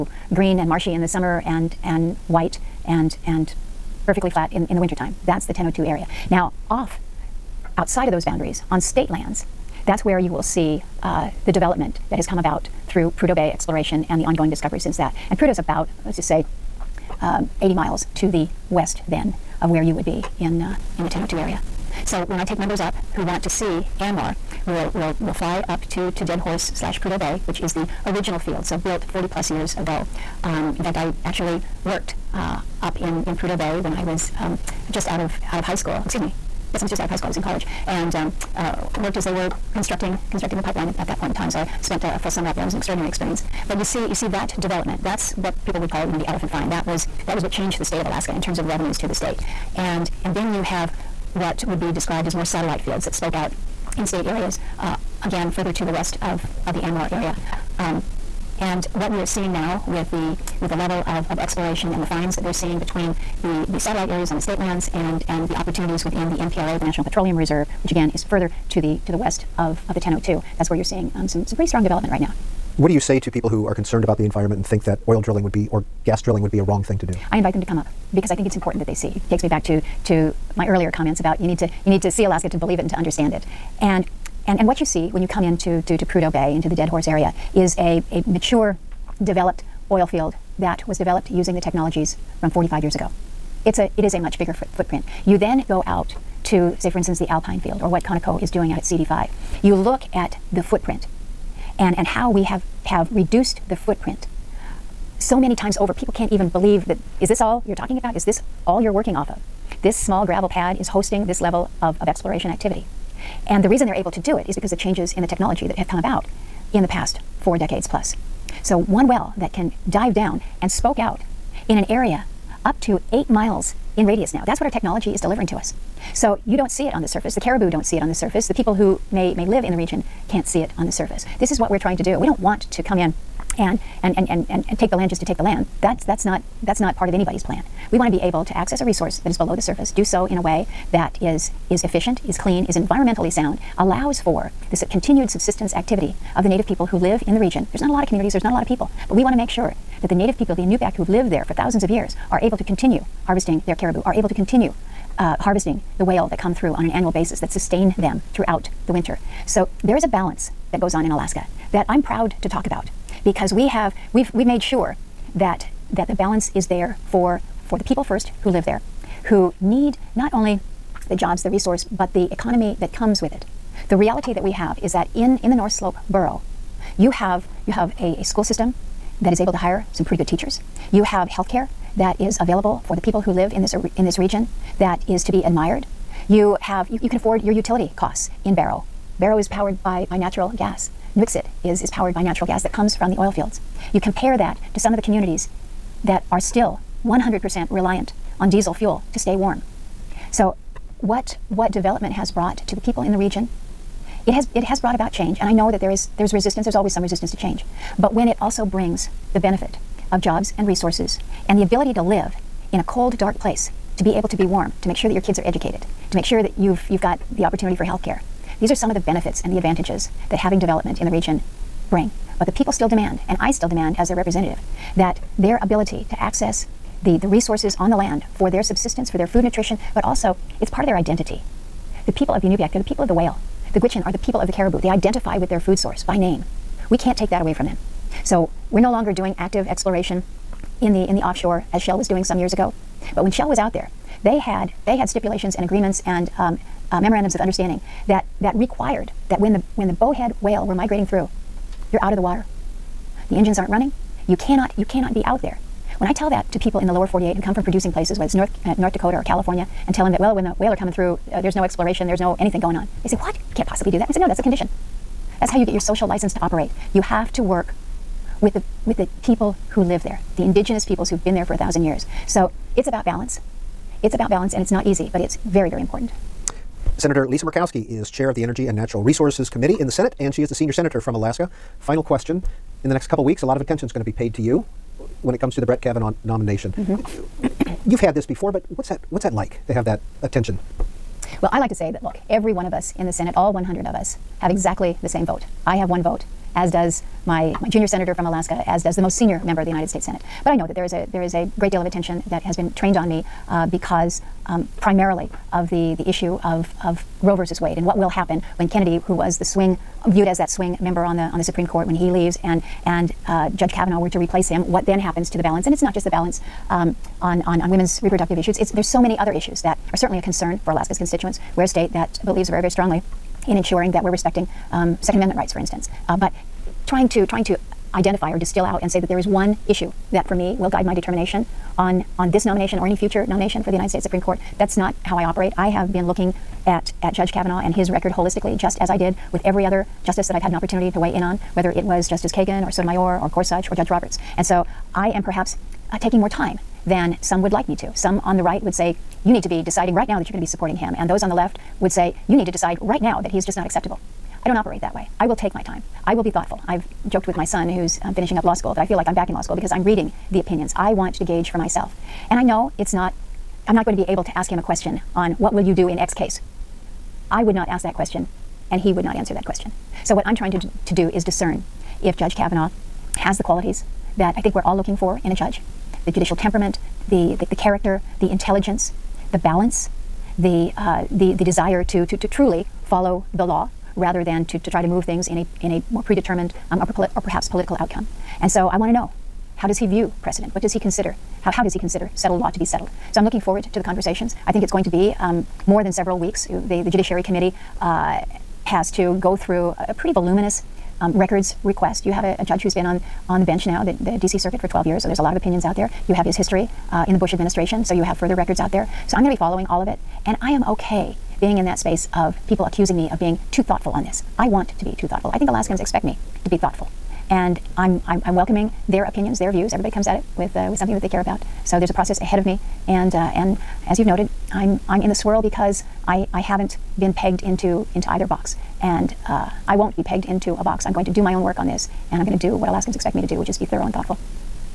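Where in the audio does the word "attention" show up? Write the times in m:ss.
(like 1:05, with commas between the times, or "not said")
4:43, 4:50, 5:01.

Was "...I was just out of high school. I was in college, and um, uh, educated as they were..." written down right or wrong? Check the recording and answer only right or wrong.
wrong.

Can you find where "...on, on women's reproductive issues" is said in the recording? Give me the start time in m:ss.
5:17.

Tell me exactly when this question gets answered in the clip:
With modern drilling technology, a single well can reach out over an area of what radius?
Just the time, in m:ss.
2:03.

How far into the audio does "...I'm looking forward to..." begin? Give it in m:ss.
6:33.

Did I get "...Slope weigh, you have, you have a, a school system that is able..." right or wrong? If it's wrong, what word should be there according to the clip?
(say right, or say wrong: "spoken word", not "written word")
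wrong: "borough", not "weigh".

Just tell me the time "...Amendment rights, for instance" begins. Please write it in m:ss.
5:25.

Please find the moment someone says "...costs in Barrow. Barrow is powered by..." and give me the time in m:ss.
3:07.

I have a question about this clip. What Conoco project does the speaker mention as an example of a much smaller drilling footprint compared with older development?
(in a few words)
CD5.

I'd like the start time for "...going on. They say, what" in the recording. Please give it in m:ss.
4:22.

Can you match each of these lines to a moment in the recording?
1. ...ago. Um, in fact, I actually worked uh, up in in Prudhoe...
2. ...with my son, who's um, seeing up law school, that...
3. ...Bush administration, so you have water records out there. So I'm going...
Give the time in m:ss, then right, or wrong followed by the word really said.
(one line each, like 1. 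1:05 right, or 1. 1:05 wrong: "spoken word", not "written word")
1. 0:29 right
2. 5:57 wrong: "finishing", not "seeing"
3. 6:47 wrong: "further", not "water".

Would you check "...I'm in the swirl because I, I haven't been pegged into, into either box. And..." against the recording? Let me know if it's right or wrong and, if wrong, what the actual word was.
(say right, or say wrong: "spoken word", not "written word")
right.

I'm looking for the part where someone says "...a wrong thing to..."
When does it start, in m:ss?
1:16.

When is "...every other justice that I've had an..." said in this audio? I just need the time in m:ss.
5:39.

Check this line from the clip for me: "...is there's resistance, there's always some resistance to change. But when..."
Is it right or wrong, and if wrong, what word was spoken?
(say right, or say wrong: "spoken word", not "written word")
right.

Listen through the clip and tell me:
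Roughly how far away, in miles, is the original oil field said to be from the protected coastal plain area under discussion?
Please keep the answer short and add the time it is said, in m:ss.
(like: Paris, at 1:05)
80 miles, at 0:17.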